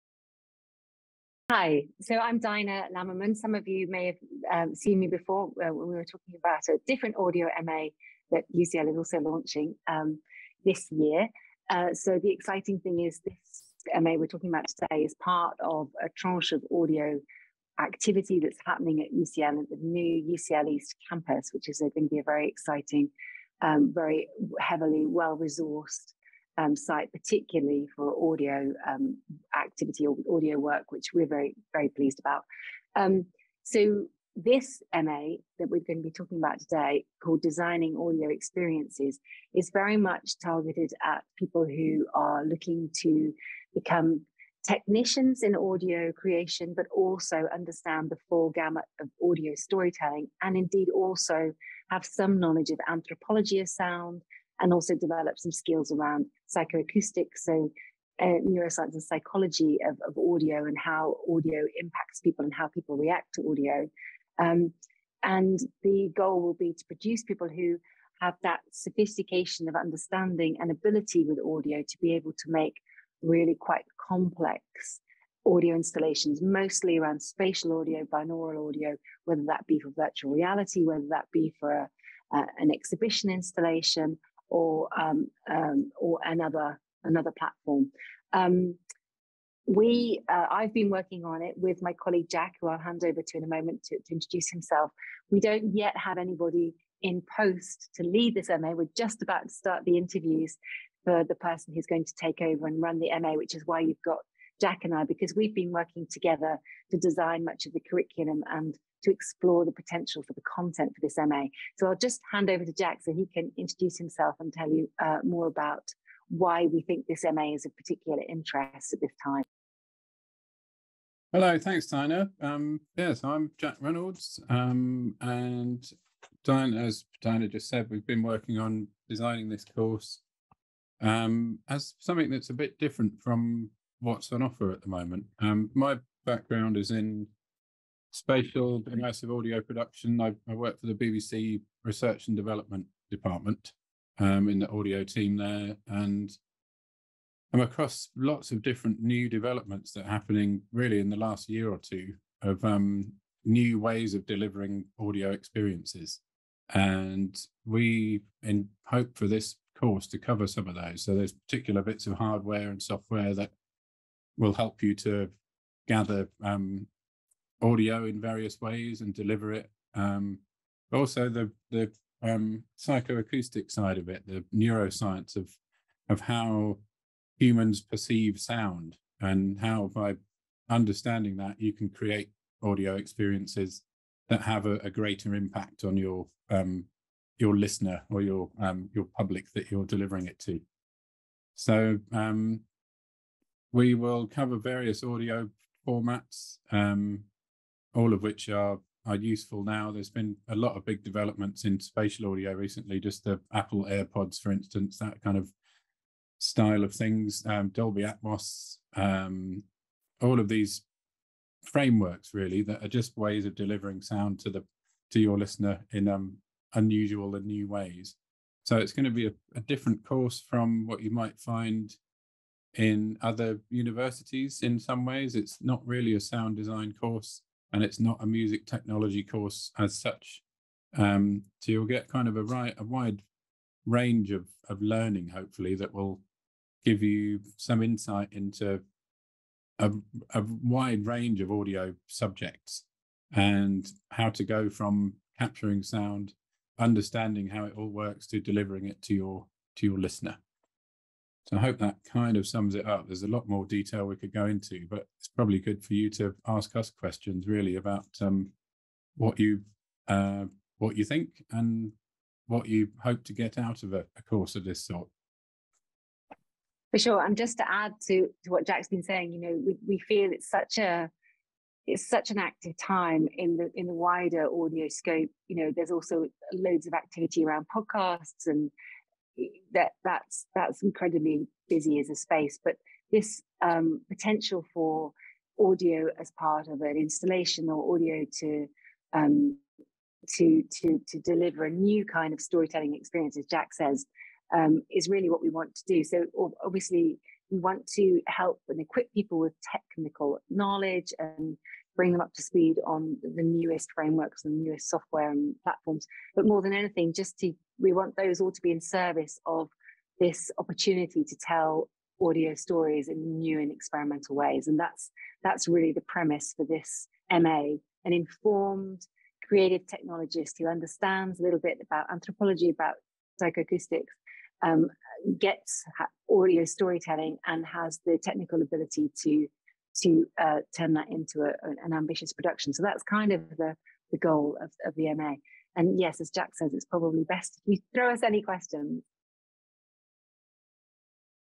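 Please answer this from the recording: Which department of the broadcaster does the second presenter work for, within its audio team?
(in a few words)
Research and Development.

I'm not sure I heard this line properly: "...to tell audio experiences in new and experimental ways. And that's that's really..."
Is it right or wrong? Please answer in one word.
wrong.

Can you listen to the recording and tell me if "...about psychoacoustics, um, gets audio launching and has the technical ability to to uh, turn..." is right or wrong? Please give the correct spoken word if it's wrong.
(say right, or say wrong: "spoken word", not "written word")
wrong: "storytelling", not "launching".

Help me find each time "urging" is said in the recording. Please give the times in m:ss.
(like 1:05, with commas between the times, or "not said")
not said.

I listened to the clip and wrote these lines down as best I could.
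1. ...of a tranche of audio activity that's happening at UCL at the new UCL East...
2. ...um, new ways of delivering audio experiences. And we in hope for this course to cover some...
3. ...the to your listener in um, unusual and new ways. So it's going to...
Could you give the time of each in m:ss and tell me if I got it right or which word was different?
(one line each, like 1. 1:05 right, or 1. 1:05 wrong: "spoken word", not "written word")
1. 0:15 right
2. 2:32 right
3. 3:34 right.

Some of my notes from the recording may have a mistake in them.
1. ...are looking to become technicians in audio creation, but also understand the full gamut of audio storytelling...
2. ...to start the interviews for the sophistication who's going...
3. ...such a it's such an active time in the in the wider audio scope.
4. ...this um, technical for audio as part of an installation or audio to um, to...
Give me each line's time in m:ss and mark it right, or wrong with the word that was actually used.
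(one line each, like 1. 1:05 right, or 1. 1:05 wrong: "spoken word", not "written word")
1. 0:42 right
2. 1:39 wrong: "person", not "sophistication"
3. 4:30 right
4. 4:43 wrong: "potential", not "technical".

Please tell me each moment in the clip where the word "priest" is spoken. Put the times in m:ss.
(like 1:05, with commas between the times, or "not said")
not said.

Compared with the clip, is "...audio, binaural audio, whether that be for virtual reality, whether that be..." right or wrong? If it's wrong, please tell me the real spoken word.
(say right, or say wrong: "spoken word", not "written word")
right.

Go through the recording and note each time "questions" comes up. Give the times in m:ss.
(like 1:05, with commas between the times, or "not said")
4:16, 5:38.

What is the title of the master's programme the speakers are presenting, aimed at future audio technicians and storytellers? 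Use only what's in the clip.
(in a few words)
Designing Audio Experiences.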